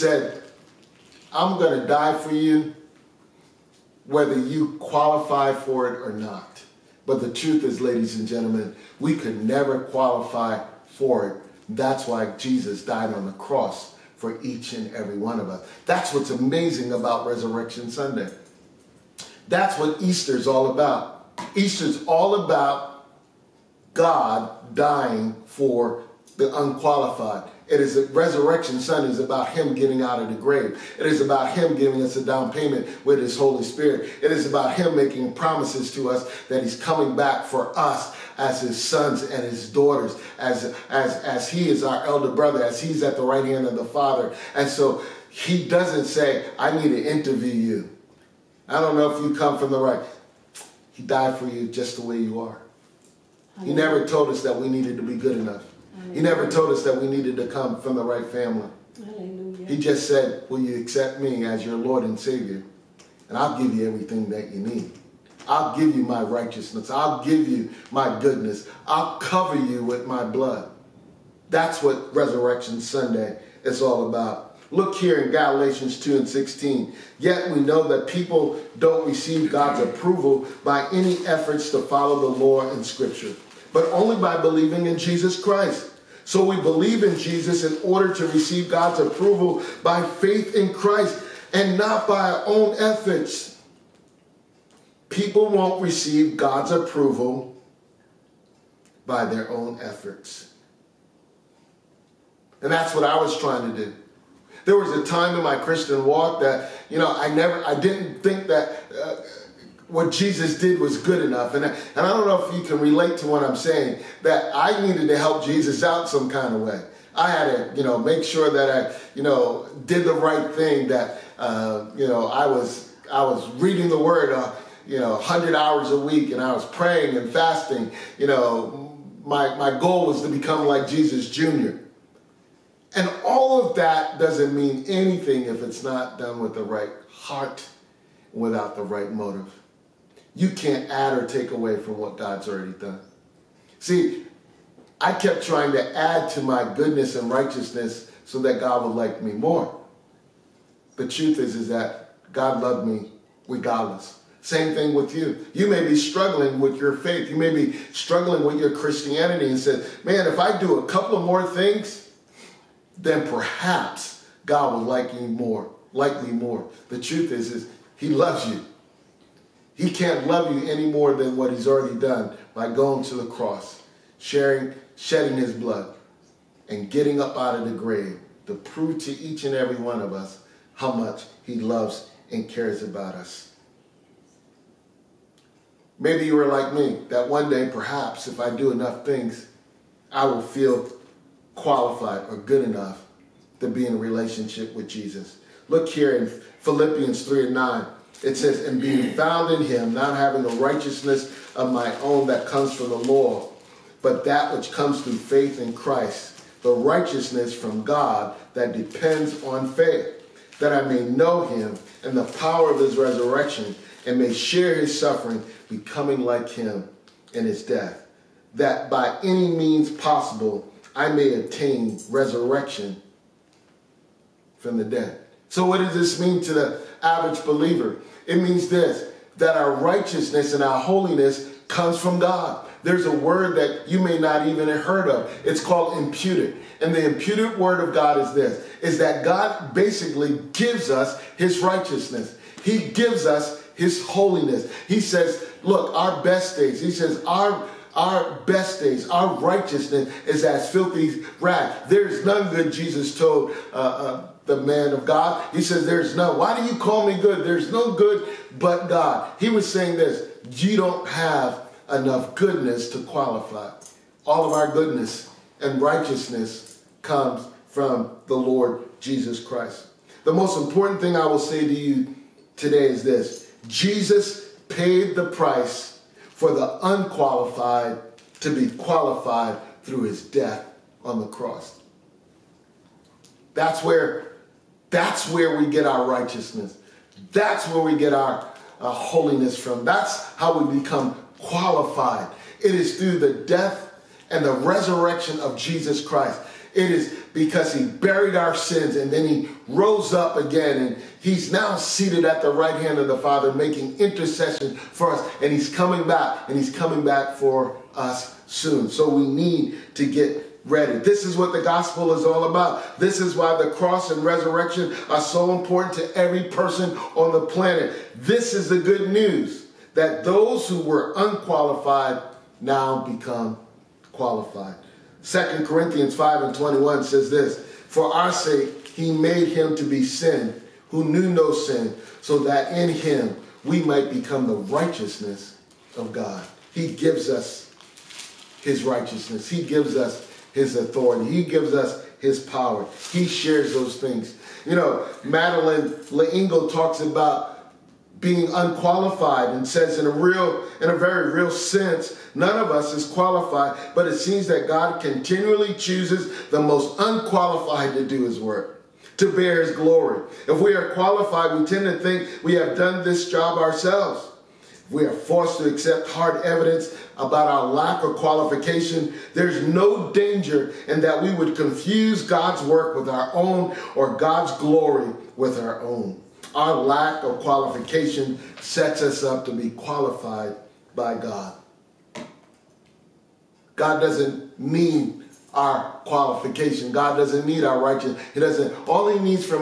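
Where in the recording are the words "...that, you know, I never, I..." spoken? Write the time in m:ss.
1:46.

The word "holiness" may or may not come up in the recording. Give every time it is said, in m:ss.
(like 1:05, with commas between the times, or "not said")
3:50, 4:04, 4:48.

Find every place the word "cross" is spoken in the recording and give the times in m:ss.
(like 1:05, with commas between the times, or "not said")
0:13, 2:53, 4:41, 5:13.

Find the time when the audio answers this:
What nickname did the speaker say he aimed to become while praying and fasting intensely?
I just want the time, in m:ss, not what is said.
2:10.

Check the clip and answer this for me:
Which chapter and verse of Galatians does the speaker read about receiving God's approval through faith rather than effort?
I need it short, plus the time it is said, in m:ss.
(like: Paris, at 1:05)
Galatians 2:16, at 1:15.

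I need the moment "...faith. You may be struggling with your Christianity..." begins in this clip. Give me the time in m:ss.
2:36.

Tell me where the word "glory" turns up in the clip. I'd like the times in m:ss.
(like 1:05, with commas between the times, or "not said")
5:59, 6:14.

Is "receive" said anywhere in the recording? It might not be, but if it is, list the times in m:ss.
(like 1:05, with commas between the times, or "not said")
1:19, 1:28, 1:35.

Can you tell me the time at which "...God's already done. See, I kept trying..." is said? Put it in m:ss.
2:22.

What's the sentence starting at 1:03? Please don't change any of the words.
And I'll give you everything that you need.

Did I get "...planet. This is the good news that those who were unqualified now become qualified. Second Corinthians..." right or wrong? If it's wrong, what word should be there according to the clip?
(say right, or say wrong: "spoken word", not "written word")
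right.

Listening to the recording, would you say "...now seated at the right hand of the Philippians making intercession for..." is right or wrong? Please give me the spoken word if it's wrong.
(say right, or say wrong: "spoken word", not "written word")
wrong: "Father", not "Philippians".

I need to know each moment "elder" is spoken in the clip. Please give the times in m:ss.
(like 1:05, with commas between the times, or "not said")
0:42.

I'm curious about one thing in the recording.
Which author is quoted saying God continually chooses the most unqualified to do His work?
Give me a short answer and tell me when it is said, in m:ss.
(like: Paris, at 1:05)
Madeleine L'Engle, at 5:45.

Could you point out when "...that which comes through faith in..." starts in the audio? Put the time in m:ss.
3:24.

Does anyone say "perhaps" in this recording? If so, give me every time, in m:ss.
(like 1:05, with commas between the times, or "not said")
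2:43, 3:07.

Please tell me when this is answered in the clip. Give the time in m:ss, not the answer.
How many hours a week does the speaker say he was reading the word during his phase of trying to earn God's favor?
2:05.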